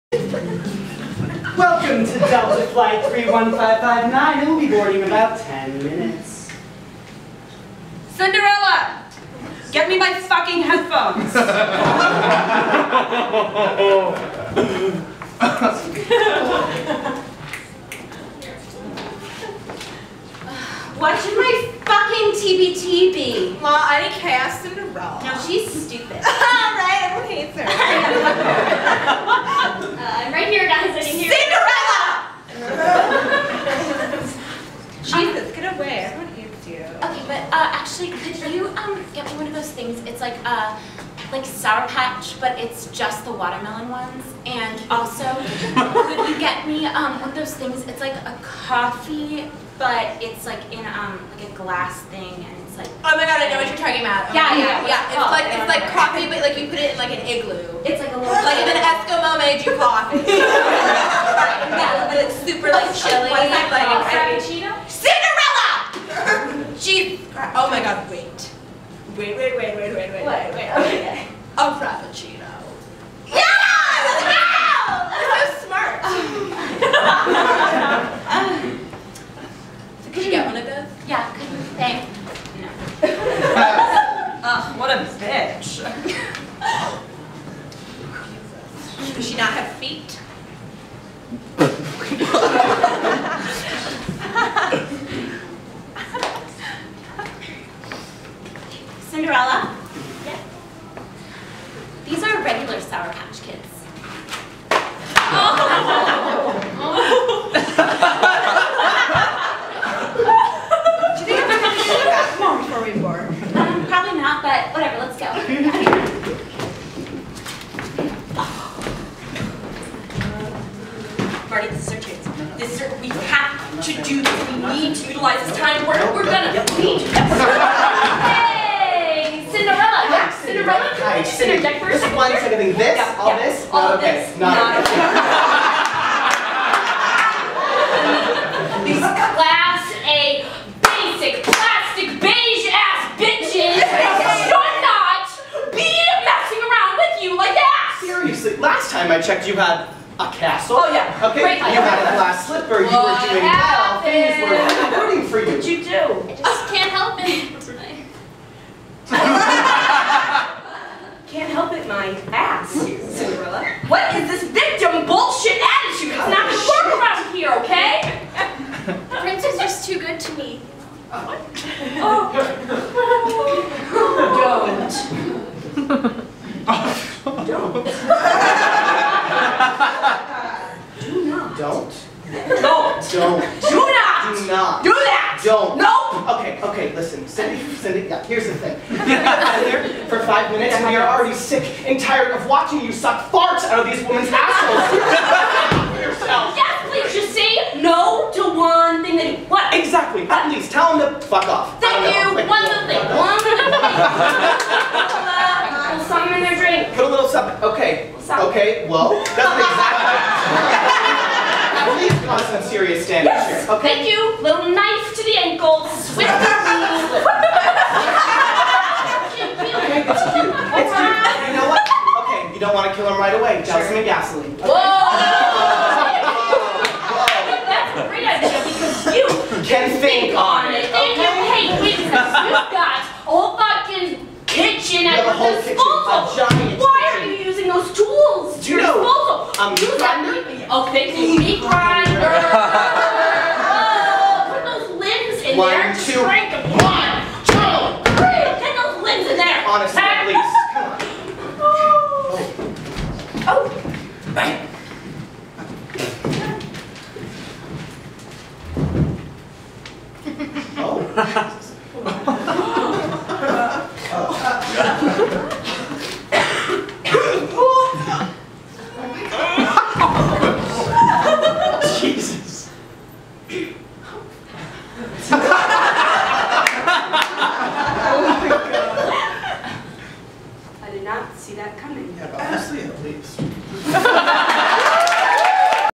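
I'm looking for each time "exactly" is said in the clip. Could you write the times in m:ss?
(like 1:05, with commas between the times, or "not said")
3:19, 3:29.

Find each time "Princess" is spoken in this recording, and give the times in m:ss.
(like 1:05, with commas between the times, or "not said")
2:49.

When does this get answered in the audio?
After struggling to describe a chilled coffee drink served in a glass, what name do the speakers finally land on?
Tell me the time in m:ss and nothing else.
1:11.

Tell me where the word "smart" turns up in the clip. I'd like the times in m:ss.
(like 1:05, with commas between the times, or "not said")
1:15.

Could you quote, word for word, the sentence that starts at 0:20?
what should my fucking TBT be?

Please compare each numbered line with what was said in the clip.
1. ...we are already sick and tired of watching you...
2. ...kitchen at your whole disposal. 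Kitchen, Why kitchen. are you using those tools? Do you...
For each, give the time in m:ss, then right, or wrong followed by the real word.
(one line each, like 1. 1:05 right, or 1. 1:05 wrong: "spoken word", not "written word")
1. 3:10 right
2. 3:54 right.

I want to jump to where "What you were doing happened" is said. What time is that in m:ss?
2:32.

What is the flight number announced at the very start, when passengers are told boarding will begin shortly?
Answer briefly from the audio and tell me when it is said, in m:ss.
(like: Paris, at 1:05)
Delta Flight 31559, at 0:02.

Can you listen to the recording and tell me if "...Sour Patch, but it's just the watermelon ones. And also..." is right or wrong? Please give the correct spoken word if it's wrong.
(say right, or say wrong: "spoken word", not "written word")
right.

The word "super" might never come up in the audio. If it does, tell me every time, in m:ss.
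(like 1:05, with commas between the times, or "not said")
1:02.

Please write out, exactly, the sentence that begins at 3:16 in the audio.
Yes, please, just say No to one thing that what?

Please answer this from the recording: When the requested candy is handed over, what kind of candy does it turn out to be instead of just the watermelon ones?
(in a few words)
Regular Sour Patch Kids.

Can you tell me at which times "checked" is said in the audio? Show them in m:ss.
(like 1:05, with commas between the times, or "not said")
2:29.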